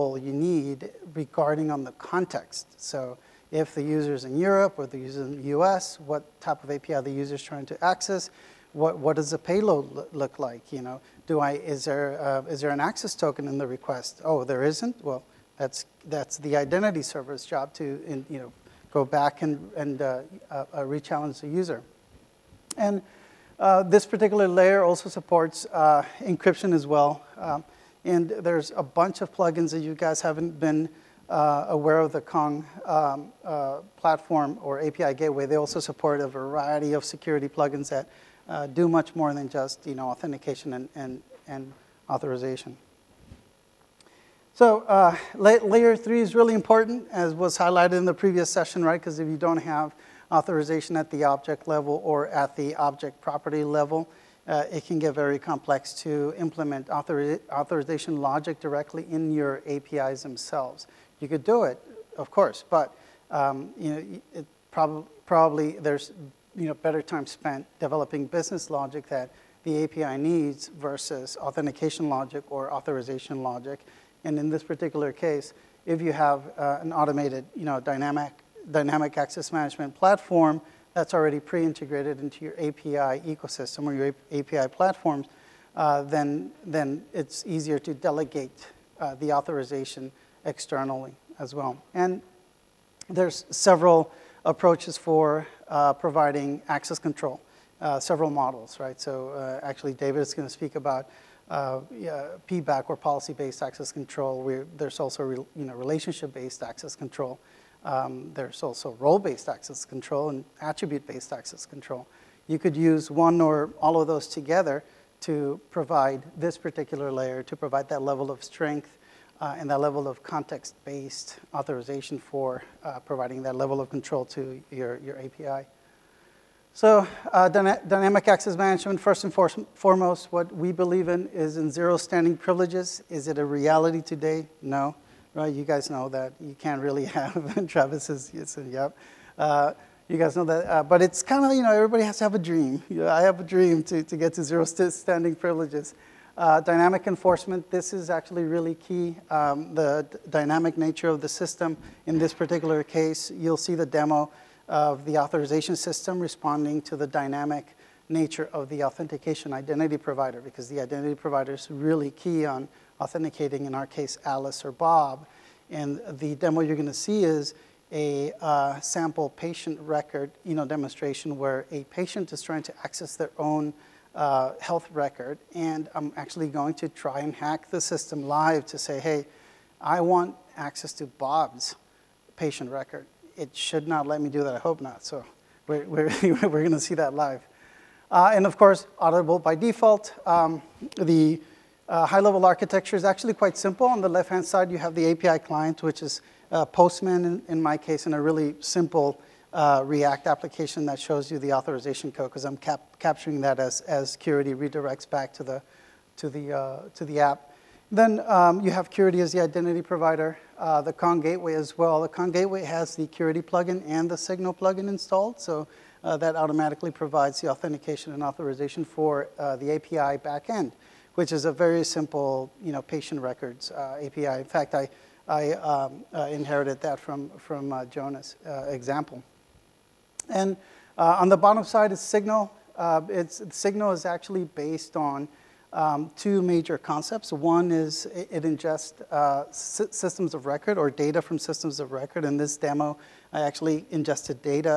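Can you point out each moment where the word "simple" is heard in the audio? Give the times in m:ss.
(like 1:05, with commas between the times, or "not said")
3:13, 3:18, 3:41.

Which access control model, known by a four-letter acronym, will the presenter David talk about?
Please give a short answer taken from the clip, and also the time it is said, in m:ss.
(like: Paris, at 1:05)
PBAC, at 1:42.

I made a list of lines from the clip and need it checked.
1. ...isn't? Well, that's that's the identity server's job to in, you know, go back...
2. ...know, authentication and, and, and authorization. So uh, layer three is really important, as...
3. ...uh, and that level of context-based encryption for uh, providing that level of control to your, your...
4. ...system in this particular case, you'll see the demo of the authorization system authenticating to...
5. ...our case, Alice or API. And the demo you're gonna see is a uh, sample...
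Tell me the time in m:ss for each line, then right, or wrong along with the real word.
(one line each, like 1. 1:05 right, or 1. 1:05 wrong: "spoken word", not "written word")
1. 0:14 right
2. 0:39 right
3. 1:59 wrong: "authorization", not "encryption"
4. 2:31 wrong: "responding", not "authenticating"
5. 2:43 wrong: "Bob", not "API".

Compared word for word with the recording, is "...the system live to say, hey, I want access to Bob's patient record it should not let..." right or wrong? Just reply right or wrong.
right.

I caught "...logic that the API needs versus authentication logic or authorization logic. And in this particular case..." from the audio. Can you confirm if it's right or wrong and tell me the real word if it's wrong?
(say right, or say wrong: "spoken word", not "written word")
right.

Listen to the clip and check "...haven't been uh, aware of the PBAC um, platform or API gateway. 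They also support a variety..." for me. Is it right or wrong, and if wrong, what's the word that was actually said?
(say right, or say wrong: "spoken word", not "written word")
wrong: "Kong", not "PBAC".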